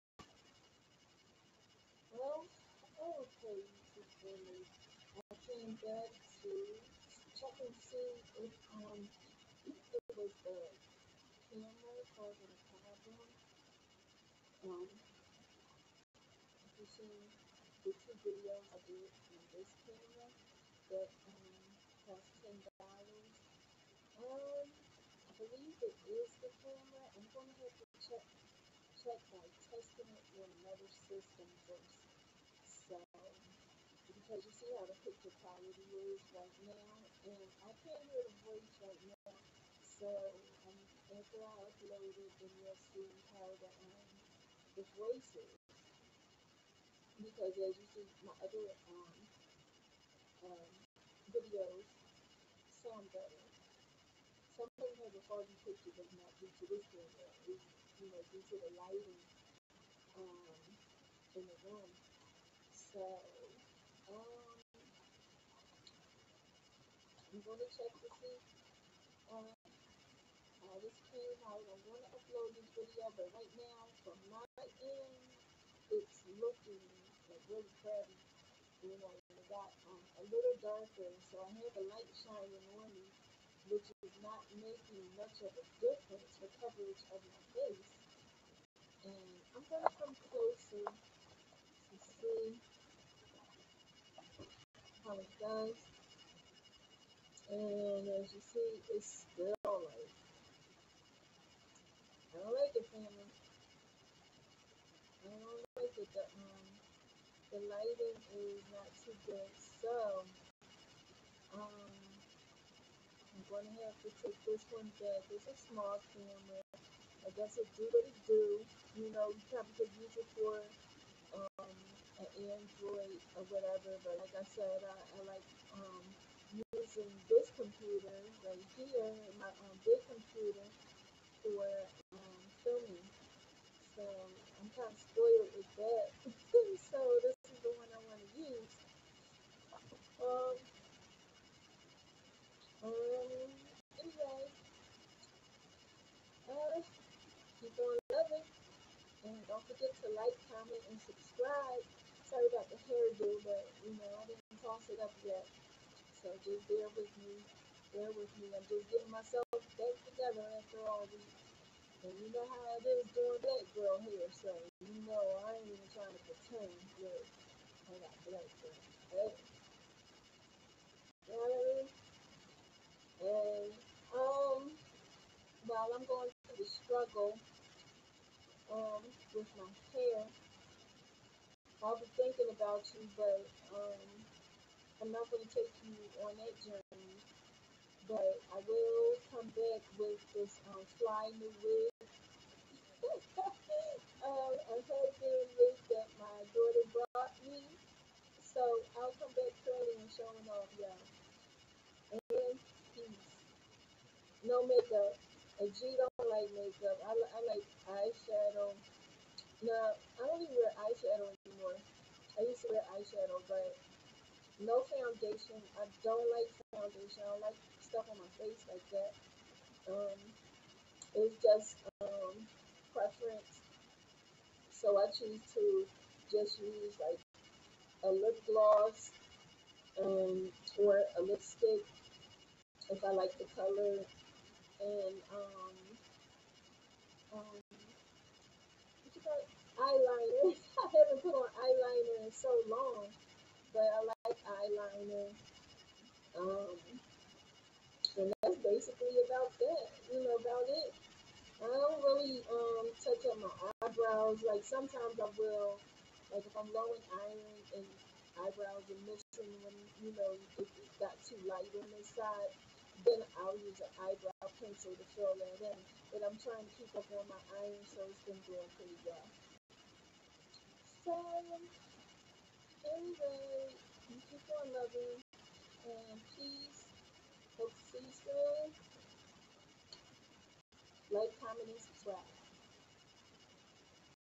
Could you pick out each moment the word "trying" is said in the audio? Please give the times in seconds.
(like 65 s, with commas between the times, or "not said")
165 s, 266 s.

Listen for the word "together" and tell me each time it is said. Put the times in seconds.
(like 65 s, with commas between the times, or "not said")
160 s.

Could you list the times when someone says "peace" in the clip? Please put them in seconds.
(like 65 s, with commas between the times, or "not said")
202 s, 276 s.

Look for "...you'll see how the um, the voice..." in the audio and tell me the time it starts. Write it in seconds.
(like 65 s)
42 s.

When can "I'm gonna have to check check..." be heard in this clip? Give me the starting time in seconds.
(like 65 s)
27 s.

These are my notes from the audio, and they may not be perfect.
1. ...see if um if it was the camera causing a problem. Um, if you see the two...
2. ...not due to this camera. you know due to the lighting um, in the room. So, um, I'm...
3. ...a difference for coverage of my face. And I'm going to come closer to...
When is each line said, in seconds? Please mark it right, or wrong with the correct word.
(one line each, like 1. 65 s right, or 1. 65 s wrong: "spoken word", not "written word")
1. 7 s right
2. 56 s right
3. 85 s right.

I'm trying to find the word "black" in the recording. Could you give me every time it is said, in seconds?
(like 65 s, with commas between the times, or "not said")
163 s, 168 s.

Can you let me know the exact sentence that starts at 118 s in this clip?
You know, you probably could use it for an Android or whatever.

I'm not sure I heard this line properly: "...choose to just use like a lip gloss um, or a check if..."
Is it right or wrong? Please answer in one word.
wrong.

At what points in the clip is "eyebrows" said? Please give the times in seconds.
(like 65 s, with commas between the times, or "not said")
253 s, 258 s, 264 s.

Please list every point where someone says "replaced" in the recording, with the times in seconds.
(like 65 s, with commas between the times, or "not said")
not said.